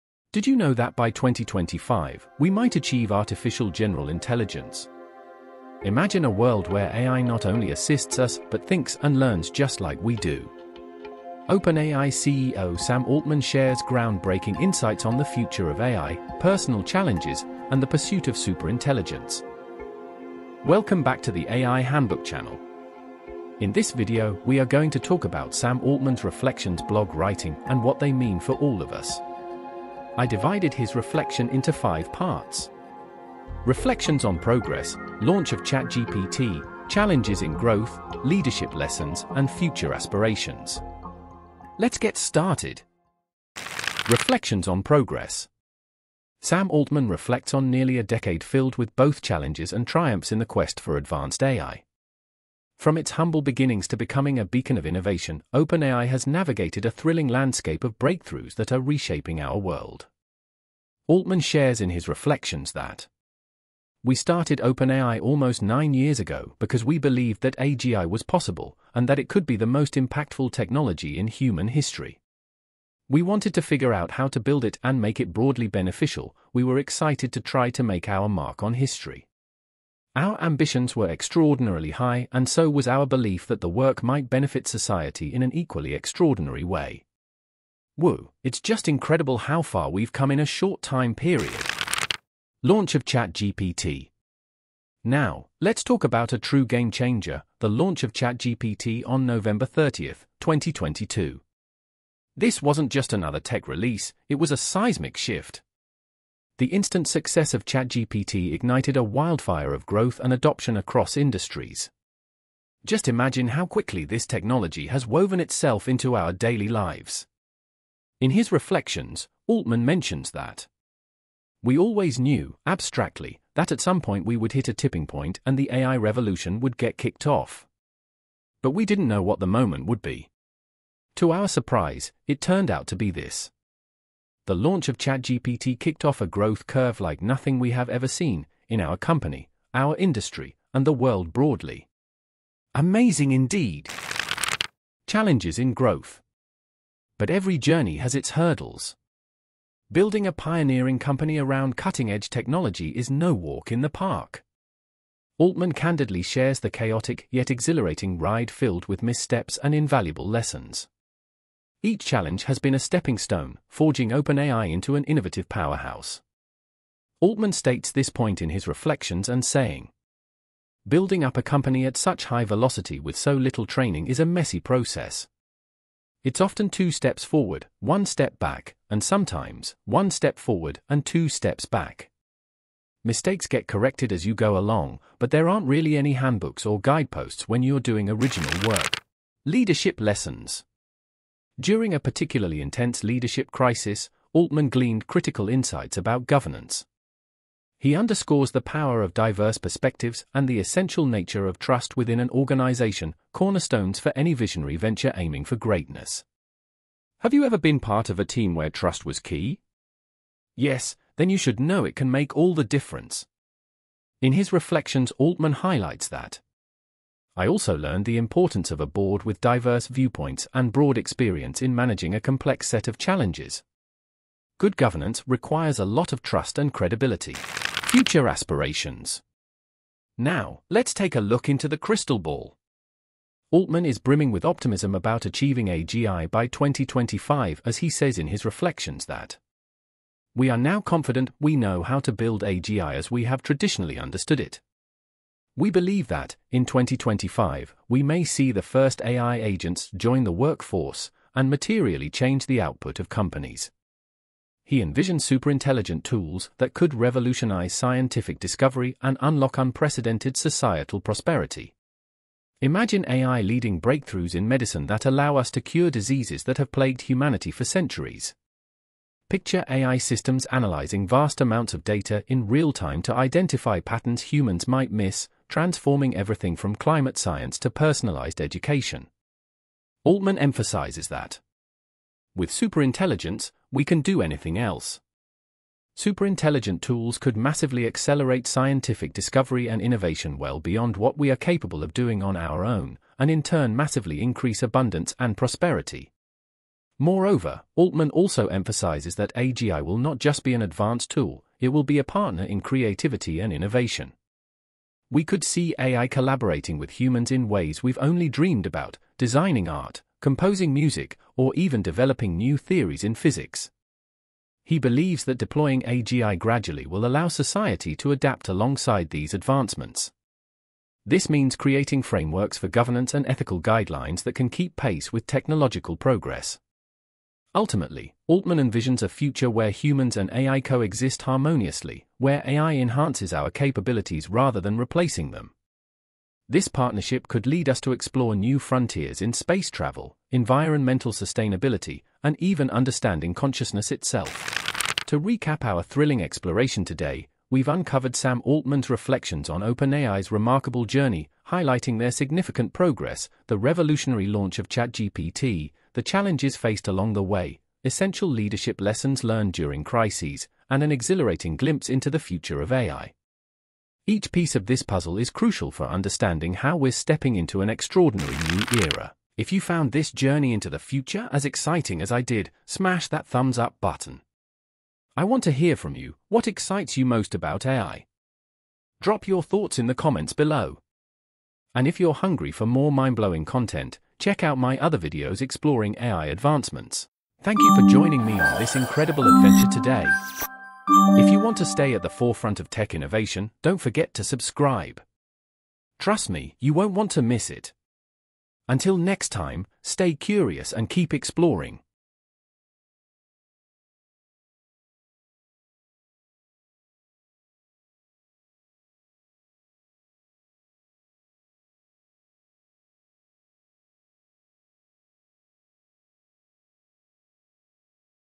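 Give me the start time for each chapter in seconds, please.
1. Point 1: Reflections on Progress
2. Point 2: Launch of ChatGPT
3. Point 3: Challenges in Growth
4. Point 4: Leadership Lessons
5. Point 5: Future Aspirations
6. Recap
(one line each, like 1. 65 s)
1. 44 s
2. 92 s
3. 144 s
4. 189 s
5. 228 s
6. 345 s.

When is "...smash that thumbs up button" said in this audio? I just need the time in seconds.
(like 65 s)
372 s.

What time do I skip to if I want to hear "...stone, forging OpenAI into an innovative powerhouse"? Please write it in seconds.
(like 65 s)
163 s.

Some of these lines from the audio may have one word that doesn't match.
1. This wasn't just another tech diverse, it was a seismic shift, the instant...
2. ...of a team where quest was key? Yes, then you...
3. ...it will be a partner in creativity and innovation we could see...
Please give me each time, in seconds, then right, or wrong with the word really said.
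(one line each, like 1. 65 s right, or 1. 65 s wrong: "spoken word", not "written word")
1. 102 s wrong: "release", not "diverse"
2. 208 s wrong: "trust", not "quest"
3. 301 s right.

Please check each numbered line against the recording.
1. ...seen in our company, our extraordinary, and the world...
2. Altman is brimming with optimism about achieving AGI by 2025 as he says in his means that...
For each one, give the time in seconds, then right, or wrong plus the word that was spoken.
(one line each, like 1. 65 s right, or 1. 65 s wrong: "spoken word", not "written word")
1. 138 s wrong: "industry", not "extraordinary"
2. 233 s wrong: "reflections", not "means".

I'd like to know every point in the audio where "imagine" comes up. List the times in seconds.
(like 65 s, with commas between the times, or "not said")
5 s, 113 s, 262 s.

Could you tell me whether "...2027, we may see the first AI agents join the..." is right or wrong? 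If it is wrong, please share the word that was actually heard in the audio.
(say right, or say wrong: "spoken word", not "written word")
wrong: "2025", not "2027".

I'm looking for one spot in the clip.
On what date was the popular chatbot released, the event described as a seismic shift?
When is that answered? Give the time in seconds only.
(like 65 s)
99 s.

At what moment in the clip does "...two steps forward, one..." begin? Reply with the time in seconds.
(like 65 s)
176 s.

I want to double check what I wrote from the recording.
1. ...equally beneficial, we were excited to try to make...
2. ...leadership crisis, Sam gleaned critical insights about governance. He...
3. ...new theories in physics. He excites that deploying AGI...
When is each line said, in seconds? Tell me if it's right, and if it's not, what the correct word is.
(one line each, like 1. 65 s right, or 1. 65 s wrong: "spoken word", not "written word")
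1. 75 s wrong: "broadly", not "equally"
2. 193 s wrong: "Altman", not "Sam"
3. 312 s wrong: "believes", not "excites".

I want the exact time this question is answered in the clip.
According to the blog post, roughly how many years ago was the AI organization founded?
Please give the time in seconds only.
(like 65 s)
65 s.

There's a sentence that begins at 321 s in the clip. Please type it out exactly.
This means creating frameworks for governance and ethical guidelines that can keep pace with technological progress.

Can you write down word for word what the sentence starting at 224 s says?
Good governance requires a lot of trust and credibility.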